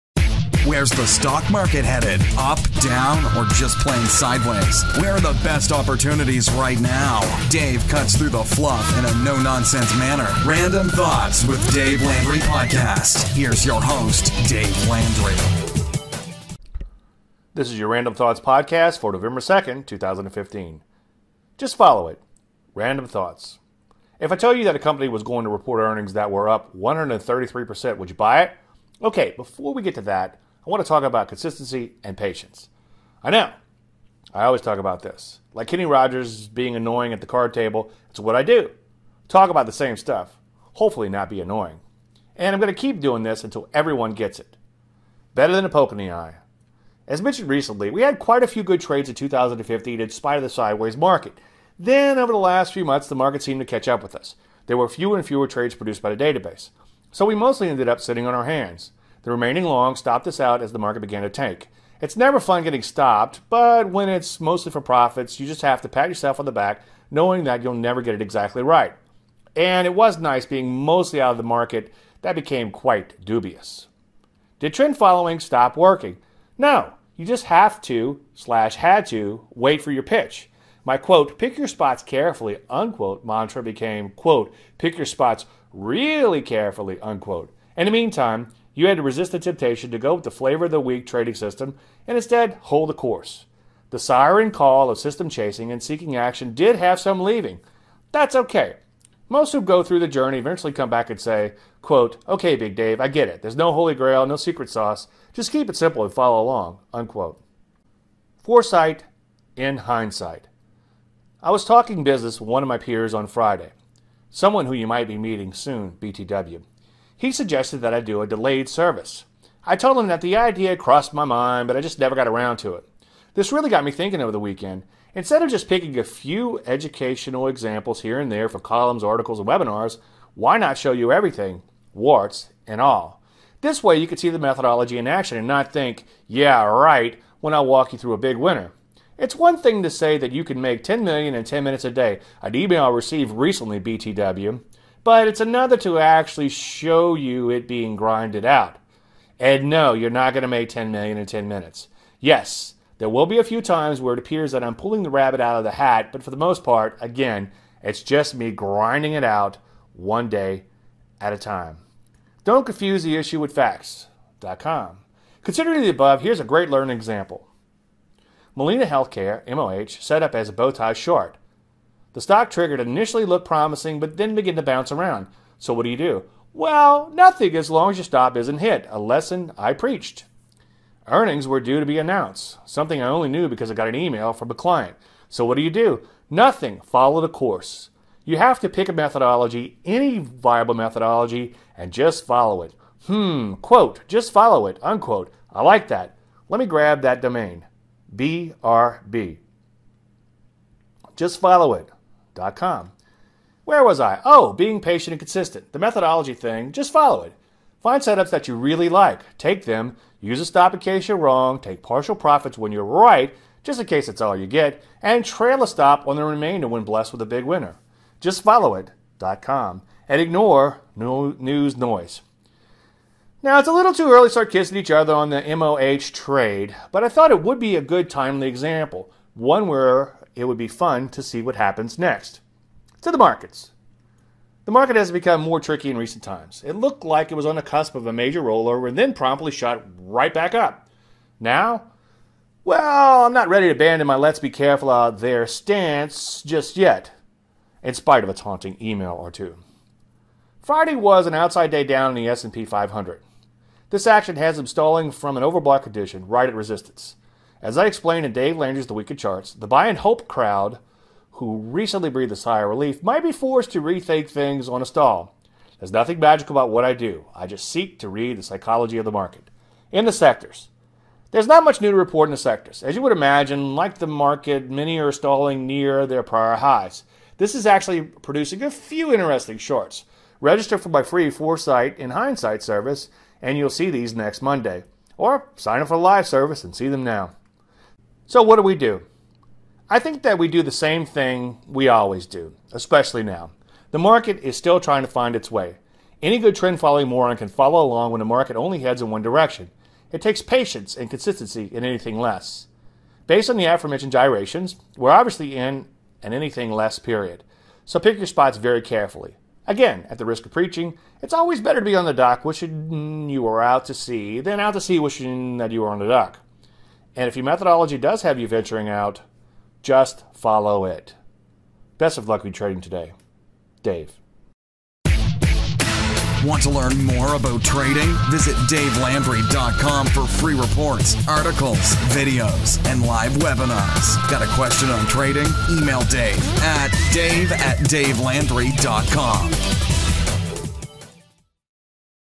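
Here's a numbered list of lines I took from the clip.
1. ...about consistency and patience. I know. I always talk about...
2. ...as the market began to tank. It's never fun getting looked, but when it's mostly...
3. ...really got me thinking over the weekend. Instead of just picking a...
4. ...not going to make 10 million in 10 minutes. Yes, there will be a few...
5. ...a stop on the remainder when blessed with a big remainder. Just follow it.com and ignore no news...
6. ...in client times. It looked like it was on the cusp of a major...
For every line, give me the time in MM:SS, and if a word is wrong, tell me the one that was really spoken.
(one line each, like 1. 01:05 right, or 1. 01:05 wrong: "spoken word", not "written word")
1. 00:31 right
2. 01:00 wrong: "stopped", not "looked"
3. 02:03 right
4. 02:30 right
5. 03:35 wrong: "winner", not "remainder"
6. 03:55 wrong: "recent", not "client".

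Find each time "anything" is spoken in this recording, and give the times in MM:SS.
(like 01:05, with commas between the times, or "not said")
05:01, 05:06.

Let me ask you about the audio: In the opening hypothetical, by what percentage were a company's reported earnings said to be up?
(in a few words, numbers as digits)
133%.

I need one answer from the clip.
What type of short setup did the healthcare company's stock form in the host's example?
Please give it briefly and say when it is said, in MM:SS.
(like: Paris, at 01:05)
bowtie short, at 02:50.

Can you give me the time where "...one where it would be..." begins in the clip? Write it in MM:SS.
03:49.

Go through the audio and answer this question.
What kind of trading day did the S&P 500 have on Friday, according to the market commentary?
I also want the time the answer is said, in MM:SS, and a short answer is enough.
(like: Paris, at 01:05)
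outside day down, at 04:11.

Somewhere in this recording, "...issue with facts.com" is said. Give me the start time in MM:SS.
02:43.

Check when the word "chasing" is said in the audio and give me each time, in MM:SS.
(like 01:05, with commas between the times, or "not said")
01:35.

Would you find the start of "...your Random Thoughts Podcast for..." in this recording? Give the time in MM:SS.
00:17.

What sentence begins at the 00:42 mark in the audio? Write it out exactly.
And I'm going to keep doing this until everyone gets it.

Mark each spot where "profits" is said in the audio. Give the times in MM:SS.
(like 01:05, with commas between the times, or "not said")
01:04, 03:32.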